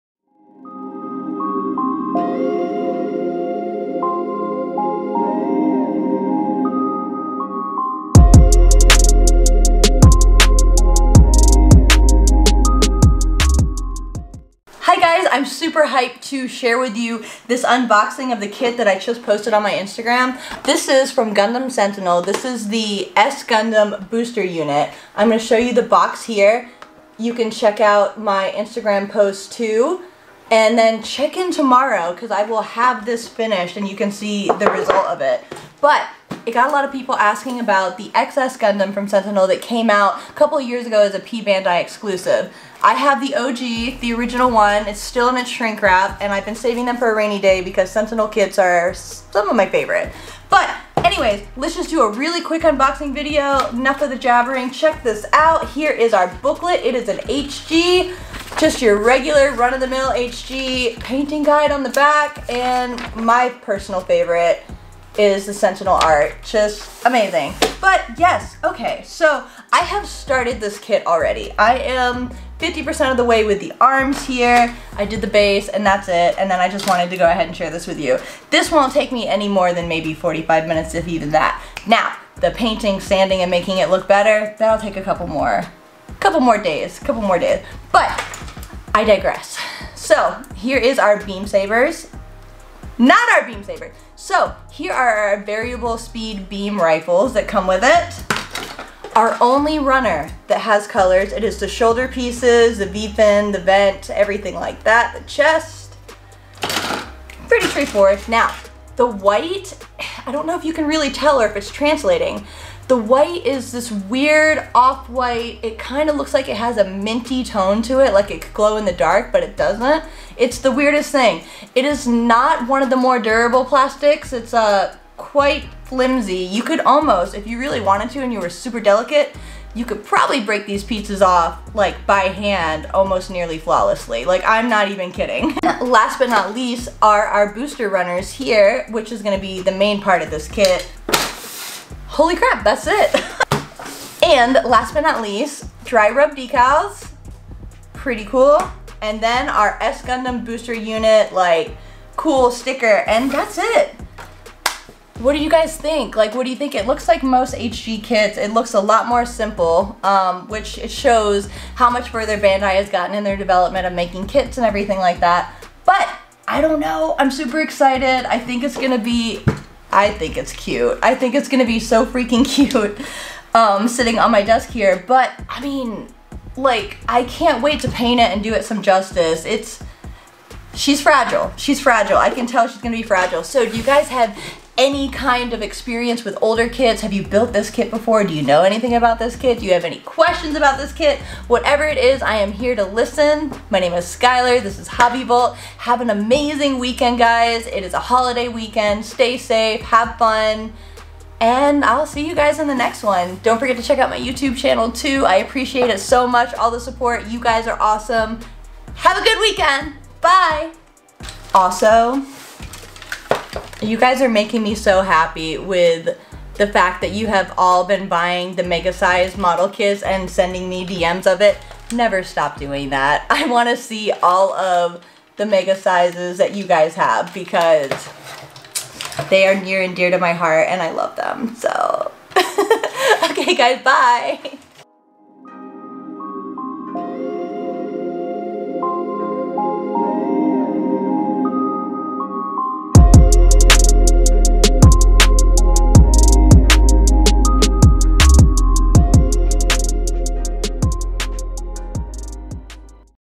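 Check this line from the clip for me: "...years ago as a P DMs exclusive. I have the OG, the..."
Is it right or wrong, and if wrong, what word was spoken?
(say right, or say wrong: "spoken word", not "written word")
wrong: "Bandai", not "DMs".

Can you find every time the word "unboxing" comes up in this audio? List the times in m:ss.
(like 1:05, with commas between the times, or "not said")
0:17, 0:52.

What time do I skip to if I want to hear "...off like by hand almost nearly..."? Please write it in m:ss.
2:11.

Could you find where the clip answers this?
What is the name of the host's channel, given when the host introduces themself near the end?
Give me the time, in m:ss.
3:14.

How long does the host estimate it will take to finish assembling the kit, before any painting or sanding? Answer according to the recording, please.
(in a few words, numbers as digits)
45 minutes.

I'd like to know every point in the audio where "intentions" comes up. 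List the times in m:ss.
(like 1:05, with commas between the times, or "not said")
not said.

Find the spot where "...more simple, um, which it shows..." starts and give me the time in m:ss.
2:39.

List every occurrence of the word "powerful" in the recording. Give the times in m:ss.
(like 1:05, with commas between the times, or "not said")
not said.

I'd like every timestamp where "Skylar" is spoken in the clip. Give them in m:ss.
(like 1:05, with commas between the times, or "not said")
3:14.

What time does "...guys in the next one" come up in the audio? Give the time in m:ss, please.
3:22.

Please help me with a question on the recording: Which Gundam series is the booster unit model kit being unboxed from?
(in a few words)
Gundam Sentinel.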